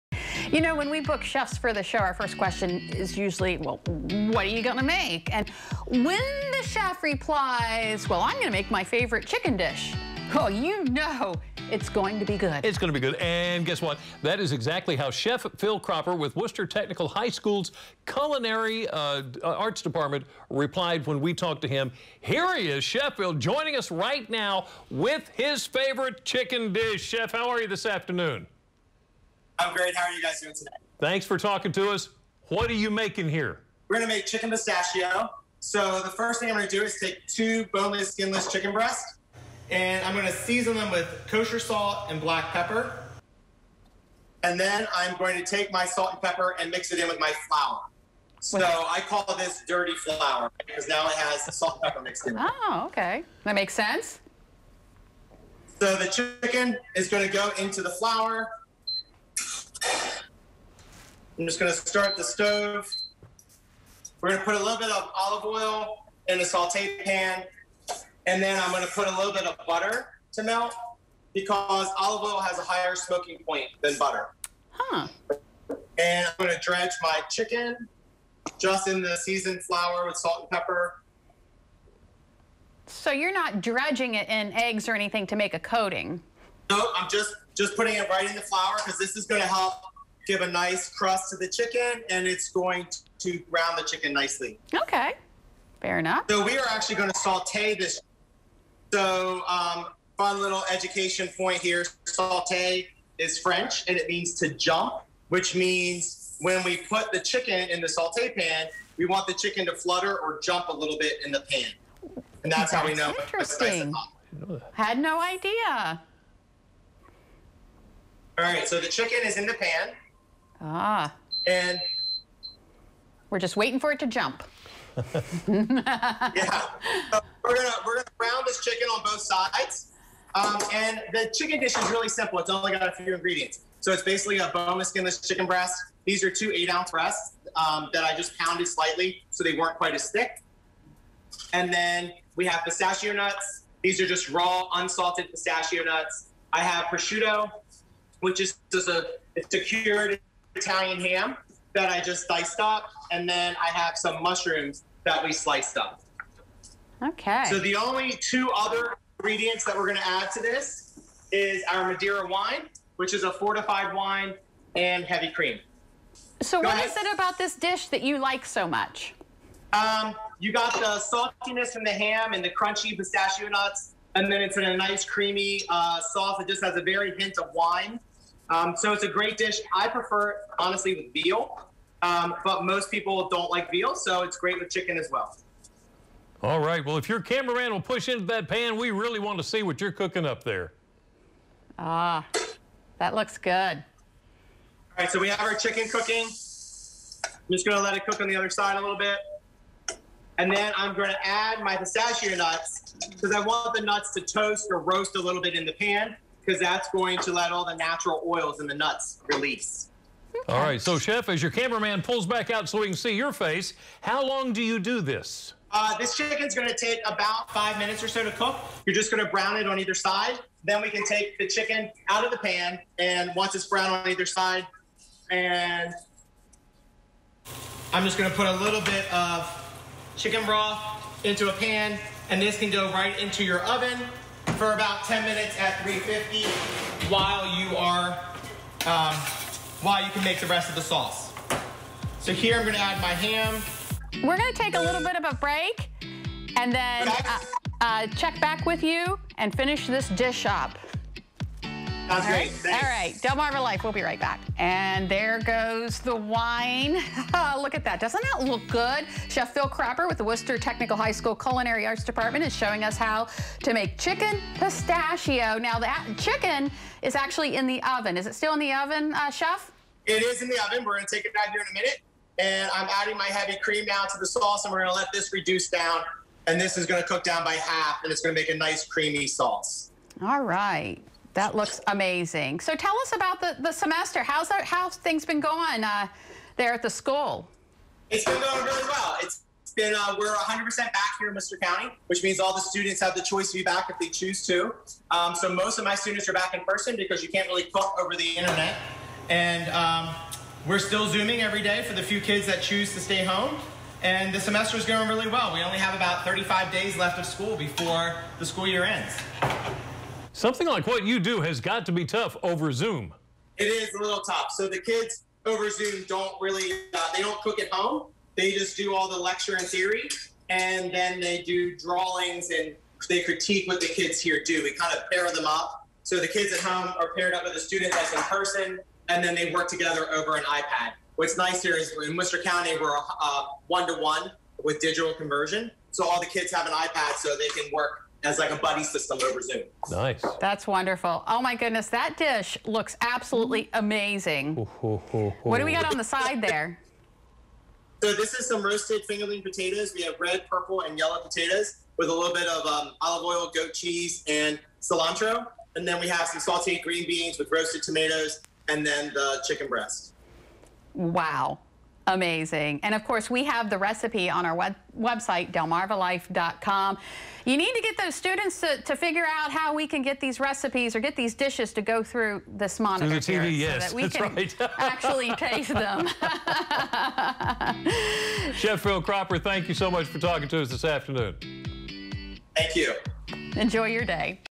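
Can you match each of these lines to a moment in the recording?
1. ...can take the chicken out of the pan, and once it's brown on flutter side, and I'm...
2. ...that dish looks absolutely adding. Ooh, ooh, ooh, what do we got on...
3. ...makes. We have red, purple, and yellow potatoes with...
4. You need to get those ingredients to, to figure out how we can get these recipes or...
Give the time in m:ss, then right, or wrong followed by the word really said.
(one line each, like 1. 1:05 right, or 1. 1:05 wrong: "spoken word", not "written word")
1. 3:40 wrong: "either", not "flutter"
2. 5:41 wrong: "amazing", not "adding"
3. 5:49 wrong: "potatoes", not "makes"
4. 6:07 wrong: "students", not "ingredients".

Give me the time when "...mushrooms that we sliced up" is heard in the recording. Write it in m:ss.
2:34.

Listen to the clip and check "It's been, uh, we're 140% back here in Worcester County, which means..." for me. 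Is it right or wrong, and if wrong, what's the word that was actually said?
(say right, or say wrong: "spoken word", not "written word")
wrong: "100", not "140".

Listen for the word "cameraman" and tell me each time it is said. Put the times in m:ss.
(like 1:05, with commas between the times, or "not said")
3:07, 3:31.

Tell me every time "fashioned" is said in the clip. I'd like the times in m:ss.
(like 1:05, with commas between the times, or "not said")
not said.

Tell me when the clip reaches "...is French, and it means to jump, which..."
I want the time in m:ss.
1:43.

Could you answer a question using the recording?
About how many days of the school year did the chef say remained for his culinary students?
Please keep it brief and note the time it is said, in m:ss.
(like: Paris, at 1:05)
35, at 5:06.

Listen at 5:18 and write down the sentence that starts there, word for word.
They just do all the lecture and theory, and then they do drawings and they critique what the kids here do.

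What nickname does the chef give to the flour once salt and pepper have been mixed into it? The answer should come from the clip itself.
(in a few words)
dirty flour.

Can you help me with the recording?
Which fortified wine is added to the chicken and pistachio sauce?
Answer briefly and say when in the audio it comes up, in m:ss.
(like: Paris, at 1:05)
Madeira, at 2:41.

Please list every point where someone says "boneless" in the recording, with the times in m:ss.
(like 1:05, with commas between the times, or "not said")
0:37, 2:14.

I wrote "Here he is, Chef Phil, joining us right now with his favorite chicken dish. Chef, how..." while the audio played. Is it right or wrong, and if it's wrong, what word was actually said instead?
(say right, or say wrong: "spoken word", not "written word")
right.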